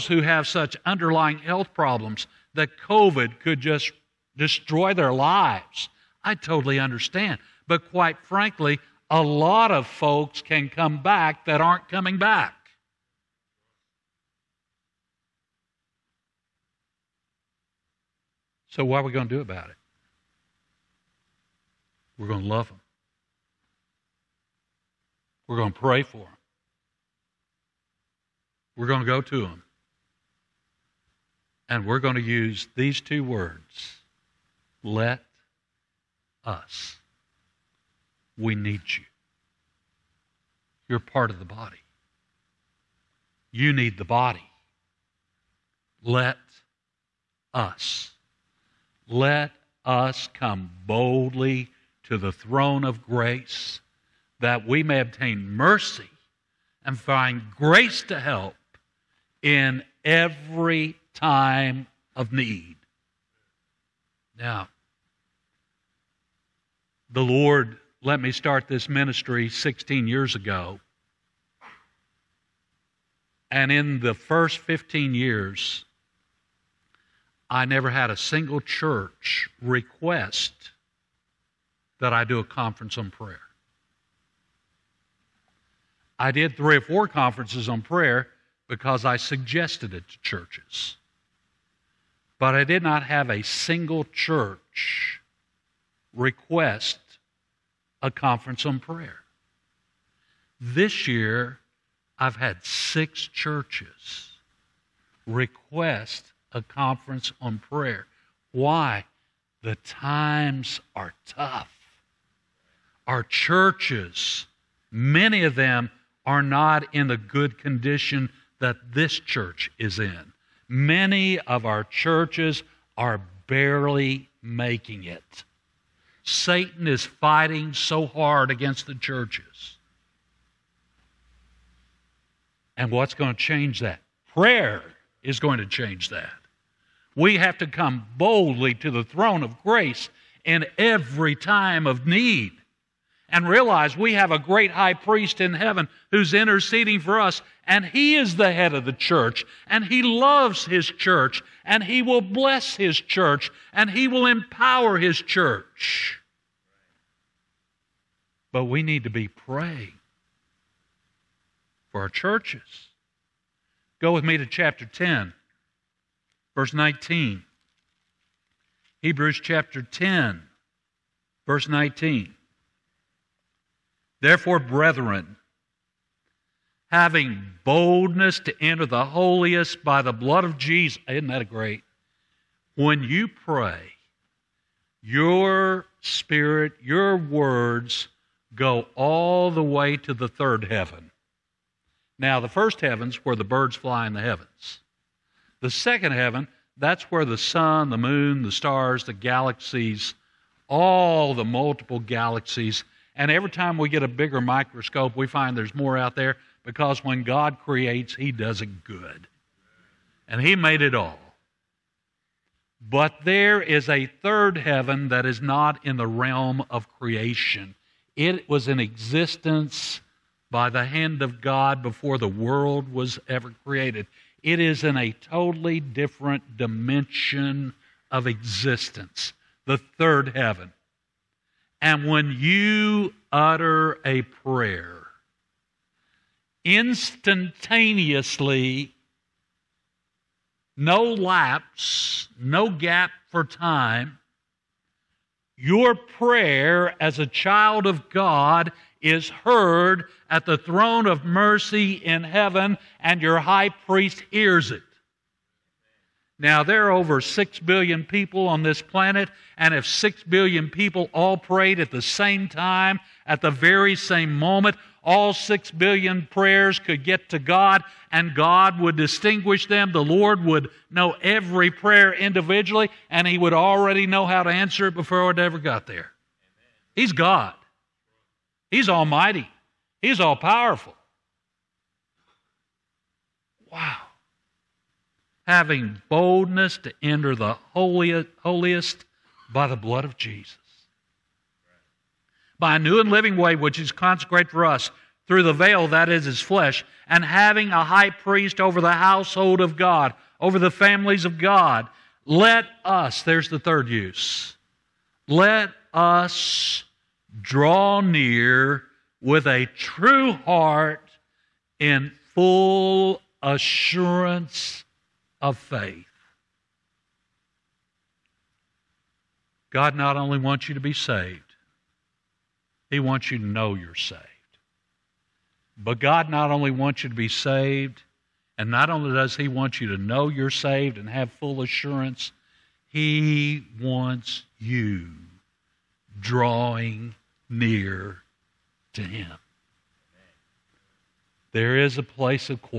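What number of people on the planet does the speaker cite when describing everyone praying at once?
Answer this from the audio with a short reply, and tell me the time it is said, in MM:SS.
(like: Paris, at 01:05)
6 billion, at 04:16.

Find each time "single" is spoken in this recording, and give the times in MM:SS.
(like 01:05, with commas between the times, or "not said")
01:18, 01:33.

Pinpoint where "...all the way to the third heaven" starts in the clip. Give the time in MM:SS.
03:08.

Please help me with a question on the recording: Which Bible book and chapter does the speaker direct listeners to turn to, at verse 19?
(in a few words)
Hebrews 10.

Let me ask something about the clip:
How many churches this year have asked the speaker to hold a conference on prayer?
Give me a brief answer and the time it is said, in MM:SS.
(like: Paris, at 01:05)
6, at 01:42.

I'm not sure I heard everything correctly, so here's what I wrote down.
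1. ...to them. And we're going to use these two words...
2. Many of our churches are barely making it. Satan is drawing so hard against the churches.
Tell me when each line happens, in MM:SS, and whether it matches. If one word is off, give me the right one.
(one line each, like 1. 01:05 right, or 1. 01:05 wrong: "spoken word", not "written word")
1. 00:29 right
2. 02:00 wrong: "fighting", not "drawing".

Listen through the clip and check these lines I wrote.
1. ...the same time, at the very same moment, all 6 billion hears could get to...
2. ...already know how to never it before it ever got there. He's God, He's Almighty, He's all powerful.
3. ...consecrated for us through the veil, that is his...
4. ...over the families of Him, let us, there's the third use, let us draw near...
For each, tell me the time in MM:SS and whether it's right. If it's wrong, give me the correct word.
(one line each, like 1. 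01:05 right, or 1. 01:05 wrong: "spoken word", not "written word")
1. 04:21 wrong: "prayers", not "hears"
2. 04:33 wrong: "answer", not "never"
3. 04:53 right
4. 05:00 wrong: "God", not "Him".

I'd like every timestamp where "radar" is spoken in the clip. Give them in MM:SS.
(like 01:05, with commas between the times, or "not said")
not said.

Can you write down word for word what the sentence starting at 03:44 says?
It is in a totally different dimension of existence, the third heaven.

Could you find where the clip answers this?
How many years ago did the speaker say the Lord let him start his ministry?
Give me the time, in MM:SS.
01:09.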